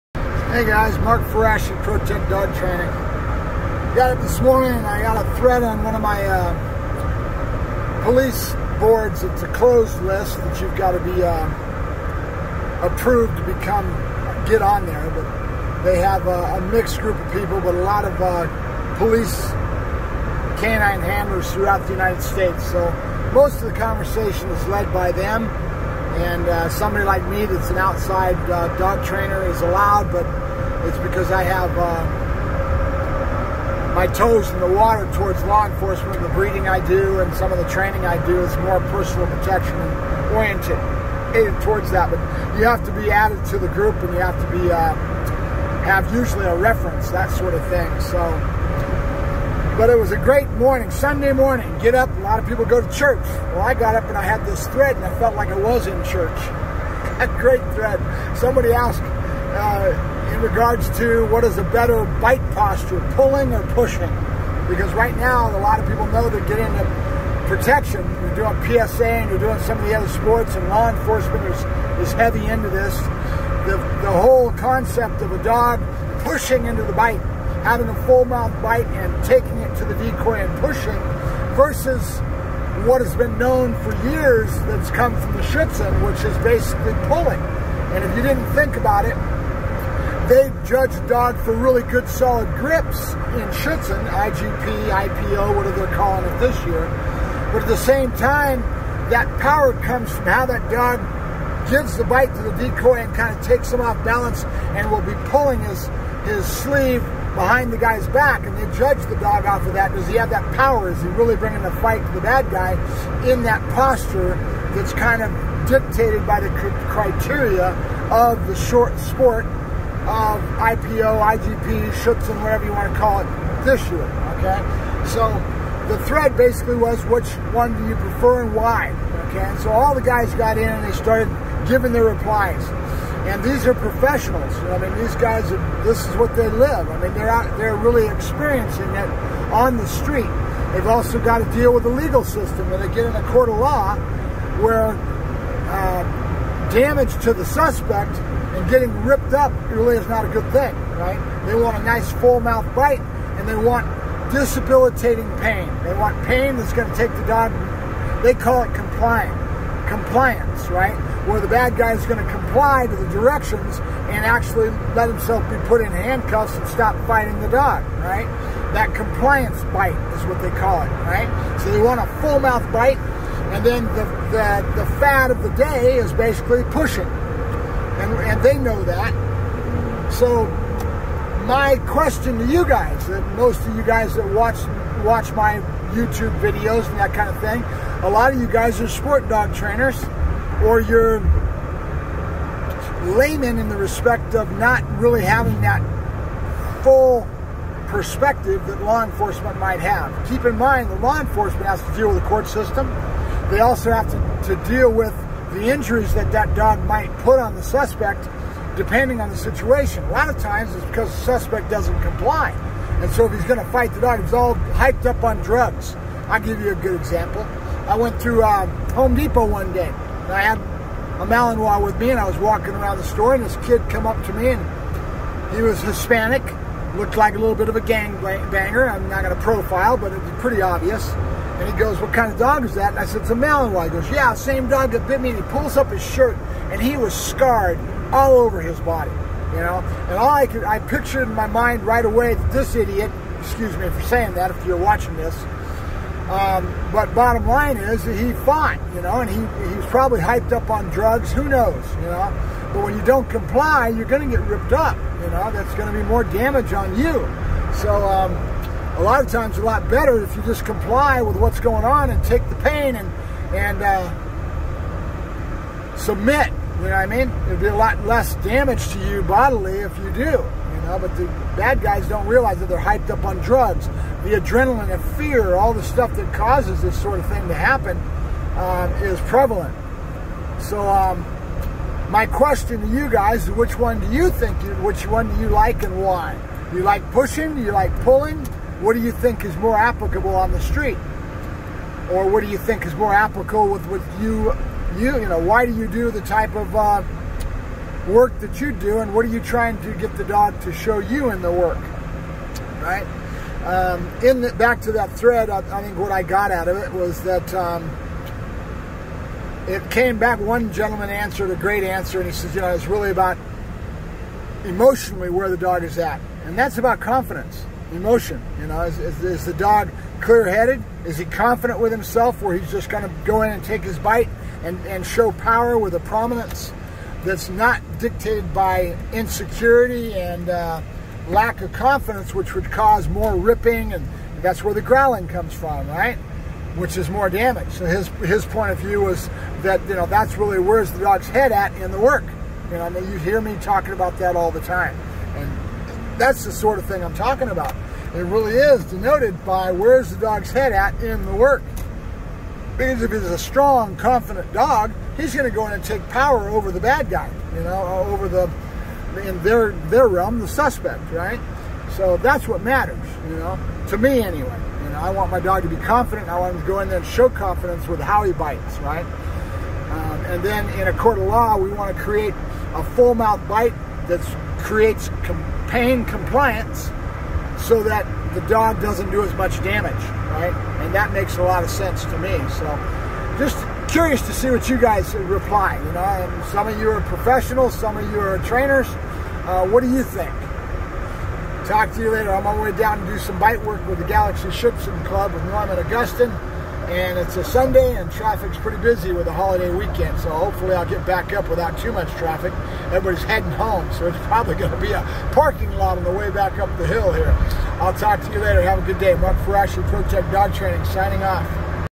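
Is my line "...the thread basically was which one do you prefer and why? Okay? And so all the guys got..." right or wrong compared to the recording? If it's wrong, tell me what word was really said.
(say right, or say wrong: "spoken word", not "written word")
right.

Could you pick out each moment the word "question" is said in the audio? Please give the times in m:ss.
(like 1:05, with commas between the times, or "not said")
3:01, 4:42.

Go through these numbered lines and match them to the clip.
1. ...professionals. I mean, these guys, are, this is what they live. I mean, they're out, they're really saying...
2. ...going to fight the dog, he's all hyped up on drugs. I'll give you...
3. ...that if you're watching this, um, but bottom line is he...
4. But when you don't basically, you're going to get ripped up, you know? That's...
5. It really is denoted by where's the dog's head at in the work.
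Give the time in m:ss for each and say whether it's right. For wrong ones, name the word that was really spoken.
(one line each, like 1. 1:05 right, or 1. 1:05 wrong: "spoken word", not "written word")
1. 2:13 wrong: "experiencing", not "saying"
2. 3:33 right
3. 4:04 right
4. 4:12 wrong: "comply", not "basically"
5. 5:48 right.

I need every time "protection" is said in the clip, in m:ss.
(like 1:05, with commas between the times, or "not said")
0:39, 1:07.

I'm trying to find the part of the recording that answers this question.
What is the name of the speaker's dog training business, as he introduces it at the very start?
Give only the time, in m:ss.
0:01.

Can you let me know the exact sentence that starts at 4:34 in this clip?
The adrenaline and fear, all the stuff that causes this sort of thing to happen, um, is prevalent.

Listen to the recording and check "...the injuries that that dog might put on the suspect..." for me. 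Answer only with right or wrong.
right.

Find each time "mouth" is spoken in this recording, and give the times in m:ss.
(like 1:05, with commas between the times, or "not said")
1:18, 2:32, 2:52, 6:13.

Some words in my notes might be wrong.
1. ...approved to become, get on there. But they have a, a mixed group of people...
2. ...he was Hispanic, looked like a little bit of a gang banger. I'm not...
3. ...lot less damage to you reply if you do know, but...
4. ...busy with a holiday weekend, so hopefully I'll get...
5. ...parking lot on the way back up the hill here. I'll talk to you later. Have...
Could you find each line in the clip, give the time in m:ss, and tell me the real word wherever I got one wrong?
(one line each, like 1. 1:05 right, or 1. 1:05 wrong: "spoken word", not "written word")
1. 0:12 right
2. 3:45 right
3. 4:27 wrong: "bodily", not "reply"
4. 6:38 right
5. 6:45 right.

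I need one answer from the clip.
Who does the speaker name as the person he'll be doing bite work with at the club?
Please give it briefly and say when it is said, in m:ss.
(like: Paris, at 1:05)
Norman Augustine, at 6:35.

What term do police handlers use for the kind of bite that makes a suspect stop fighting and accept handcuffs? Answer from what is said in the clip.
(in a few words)
compliance bite.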